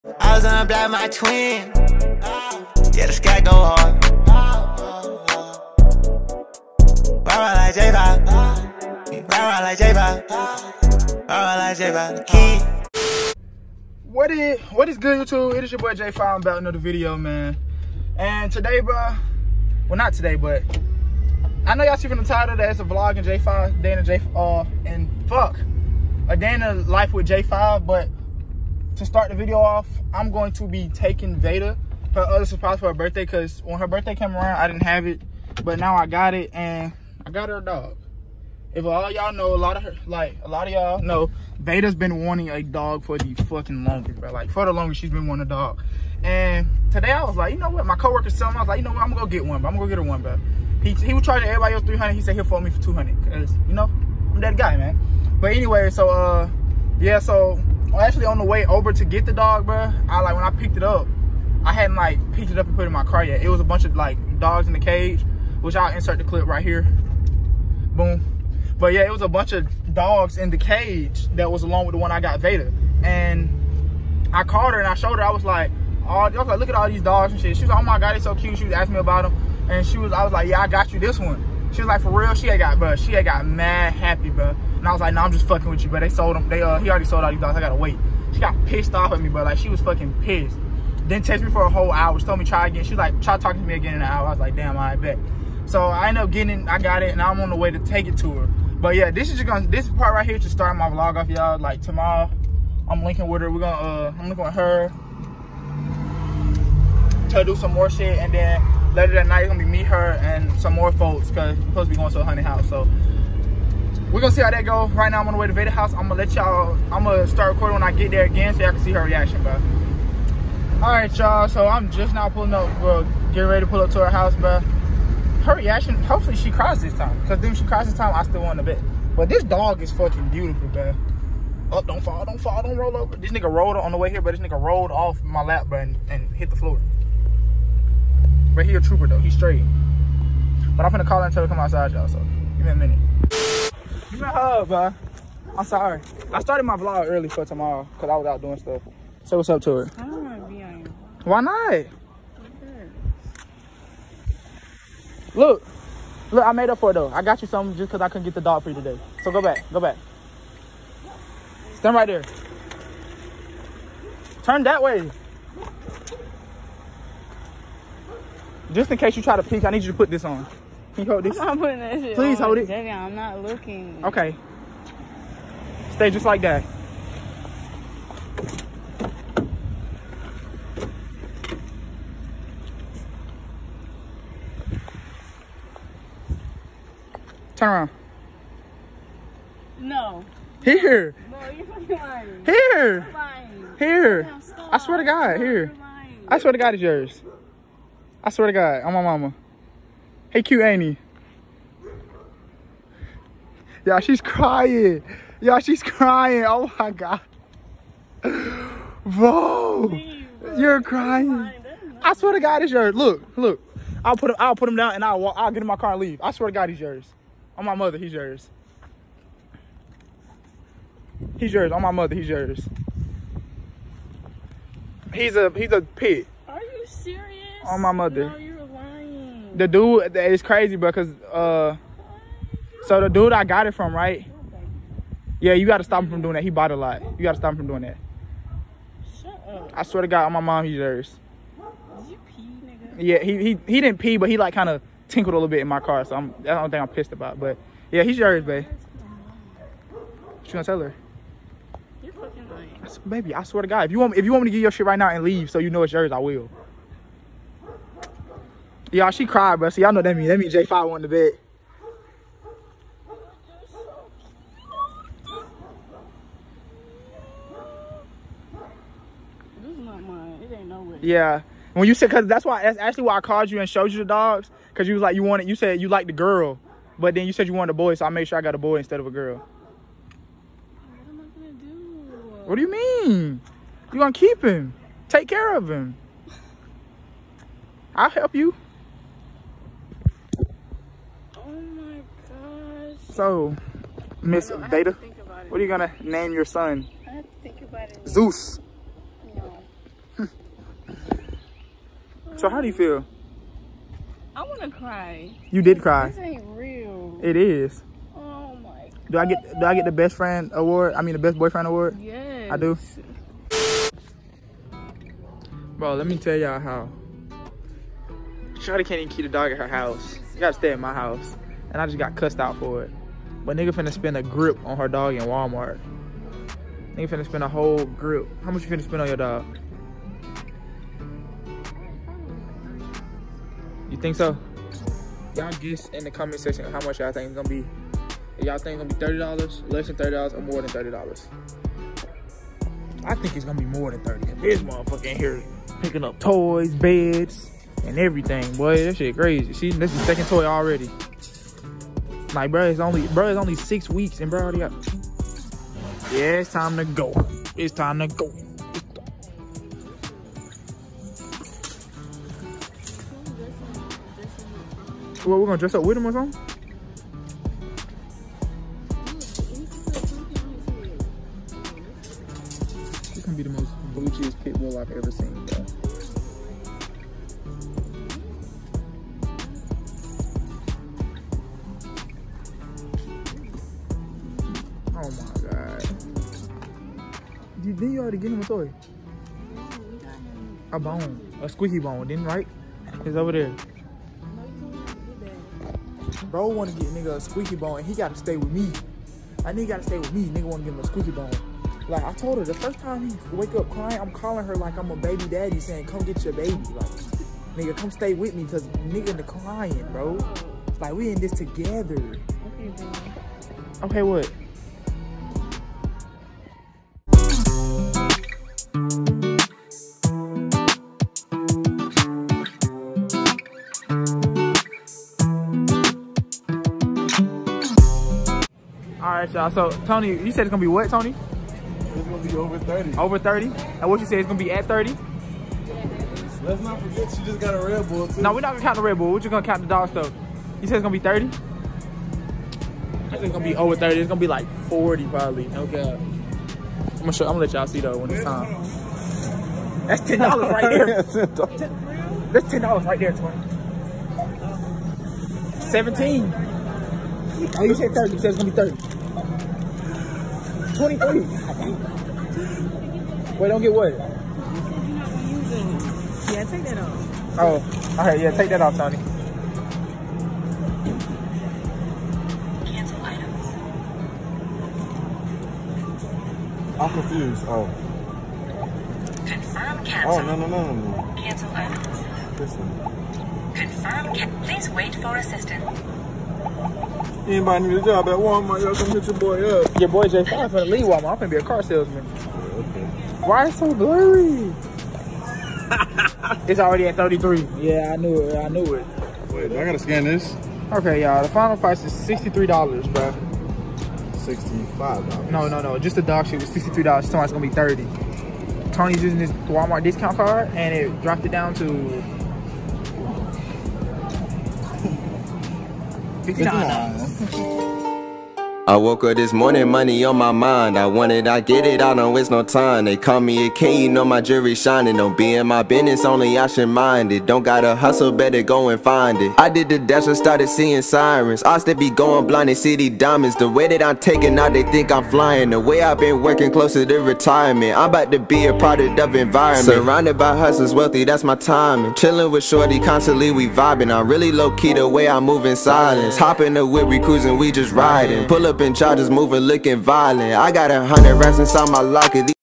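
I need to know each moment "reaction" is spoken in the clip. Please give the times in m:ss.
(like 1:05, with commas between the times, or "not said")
1:59, 2:05.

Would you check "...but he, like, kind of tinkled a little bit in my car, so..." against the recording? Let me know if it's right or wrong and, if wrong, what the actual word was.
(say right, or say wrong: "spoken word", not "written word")
right.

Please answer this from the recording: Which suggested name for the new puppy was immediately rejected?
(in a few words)
Zeus.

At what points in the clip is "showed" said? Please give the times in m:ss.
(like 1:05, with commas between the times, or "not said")
1:14, 4:33.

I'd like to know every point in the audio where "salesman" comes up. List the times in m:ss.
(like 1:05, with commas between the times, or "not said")
8:11.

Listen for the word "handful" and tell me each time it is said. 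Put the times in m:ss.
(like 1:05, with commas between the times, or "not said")
not said.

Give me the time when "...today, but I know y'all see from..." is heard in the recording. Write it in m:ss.
0:20.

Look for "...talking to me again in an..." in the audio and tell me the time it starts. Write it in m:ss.
1:33.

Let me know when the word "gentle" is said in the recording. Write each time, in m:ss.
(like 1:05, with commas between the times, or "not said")
not said.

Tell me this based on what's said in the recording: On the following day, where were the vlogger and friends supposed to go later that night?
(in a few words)
a honey house.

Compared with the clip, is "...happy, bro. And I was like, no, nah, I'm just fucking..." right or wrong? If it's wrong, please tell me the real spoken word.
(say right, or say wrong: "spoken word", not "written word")
right.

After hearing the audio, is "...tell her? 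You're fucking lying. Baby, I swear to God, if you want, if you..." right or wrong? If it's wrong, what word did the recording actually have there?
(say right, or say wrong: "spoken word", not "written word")
right.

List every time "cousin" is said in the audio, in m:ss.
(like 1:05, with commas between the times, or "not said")
not said.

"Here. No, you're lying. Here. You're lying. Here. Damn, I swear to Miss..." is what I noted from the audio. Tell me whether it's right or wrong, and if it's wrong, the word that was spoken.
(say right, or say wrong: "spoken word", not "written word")
wrong: "God", not "Miss".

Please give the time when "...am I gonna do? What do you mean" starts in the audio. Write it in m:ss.
4:41.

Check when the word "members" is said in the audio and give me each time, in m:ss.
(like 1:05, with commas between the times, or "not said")
not said.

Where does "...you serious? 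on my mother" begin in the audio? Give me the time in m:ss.
3:46.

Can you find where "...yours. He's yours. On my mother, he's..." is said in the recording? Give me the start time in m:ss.
3:38.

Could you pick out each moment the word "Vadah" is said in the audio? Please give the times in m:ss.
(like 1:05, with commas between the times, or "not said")
0:31, 0:41, 1:12, 1:55.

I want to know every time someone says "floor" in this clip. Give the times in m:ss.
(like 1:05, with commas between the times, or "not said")
2:16.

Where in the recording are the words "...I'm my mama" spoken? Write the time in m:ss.
3:18.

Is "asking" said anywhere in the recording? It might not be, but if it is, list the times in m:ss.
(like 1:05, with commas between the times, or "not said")
1:18.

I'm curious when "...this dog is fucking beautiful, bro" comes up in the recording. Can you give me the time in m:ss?
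2:09.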